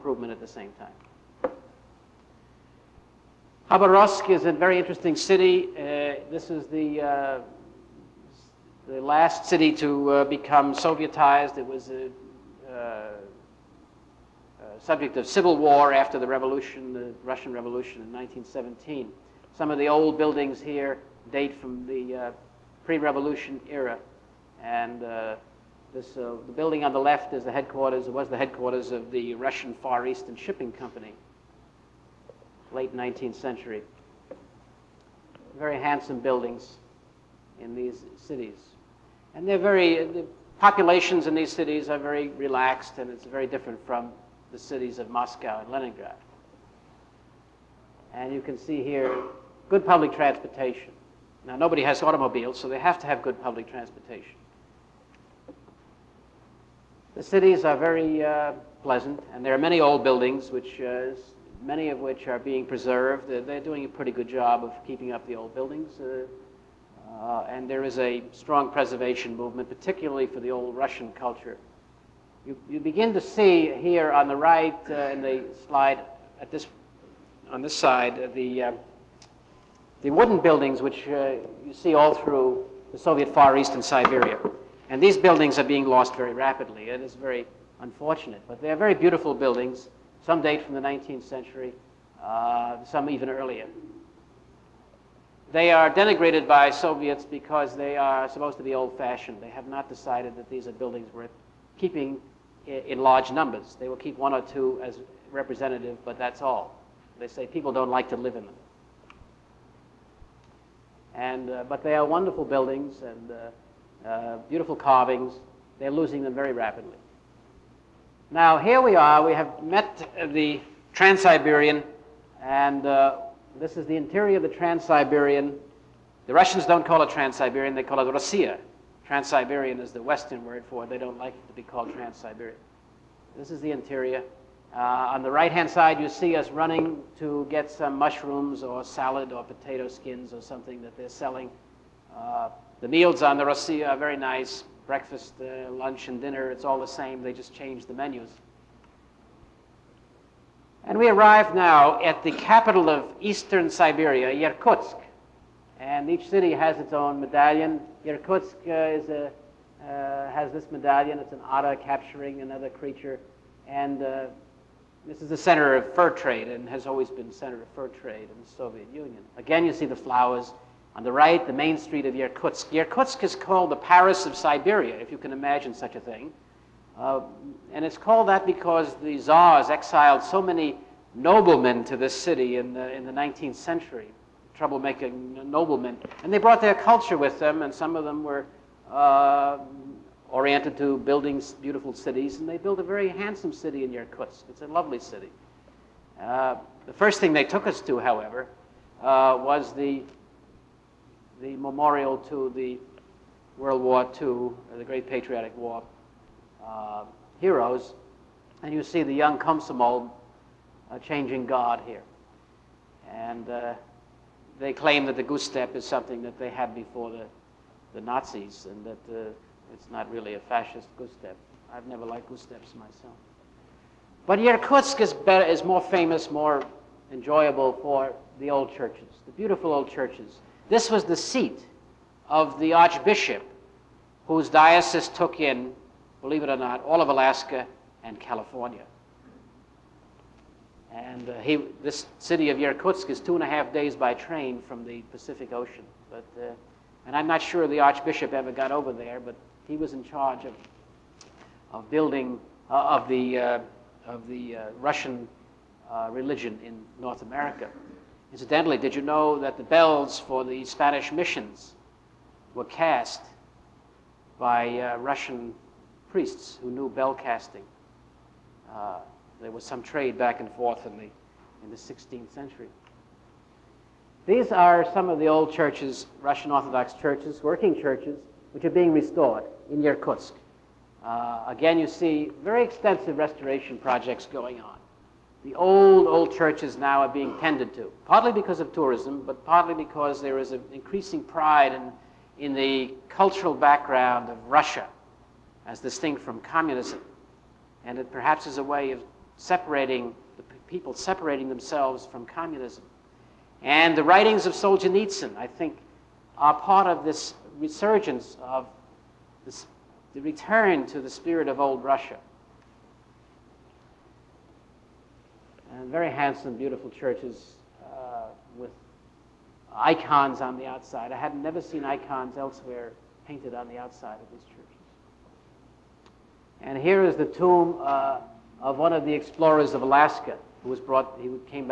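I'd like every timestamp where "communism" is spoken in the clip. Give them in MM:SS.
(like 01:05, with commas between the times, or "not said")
04:56, 05:02.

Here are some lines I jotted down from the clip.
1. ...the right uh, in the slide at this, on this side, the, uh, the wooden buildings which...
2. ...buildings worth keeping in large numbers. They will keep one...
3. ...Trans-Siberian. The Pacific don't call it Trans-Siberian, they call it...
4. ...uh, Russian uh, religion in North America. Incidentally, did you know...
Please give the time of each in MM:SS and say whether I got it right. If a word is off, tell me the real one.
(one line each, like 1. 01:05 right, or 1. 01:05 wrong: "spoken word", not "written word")
1. 01:14 right
2. 01:40 right
3. 02:04 wrong: "Russians", not "Pacific"
4. 04:14 right.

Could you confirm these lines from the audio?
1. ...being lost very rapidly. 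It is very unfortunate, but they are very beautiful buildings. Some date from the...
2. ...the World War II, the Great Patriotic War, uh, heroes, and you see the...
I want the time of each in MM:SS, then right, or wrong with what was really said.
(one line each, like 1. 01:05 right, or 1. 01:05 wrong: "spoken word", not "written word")
1. 01:25 right
2. 03:22 right.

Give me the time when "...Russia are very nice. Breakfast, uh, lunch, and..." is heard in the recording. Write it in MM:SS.
02:23.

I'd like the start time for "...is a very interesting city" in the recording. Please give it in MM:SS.
00:04.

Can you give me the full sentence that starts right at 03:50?
This was the seat of the archbishop whose diocese took in believe it or not, all of Alaska and California.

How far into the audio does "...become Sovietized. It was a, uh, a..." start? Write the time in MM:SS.
00:10.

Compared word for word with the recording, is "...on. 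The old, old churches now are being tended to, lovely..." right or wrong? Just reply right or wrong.
wrong.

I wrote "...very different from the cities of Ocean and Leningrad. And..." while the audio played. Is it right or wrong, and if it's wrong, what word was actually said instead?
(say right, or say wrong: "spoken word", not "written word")
wrong: "Moscow", not "Ocean".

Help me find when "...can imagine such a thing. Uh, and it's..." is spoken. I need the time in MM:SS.
02:55.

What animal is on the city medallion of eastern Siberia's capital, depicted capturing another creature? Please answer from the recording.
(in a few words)
An otter.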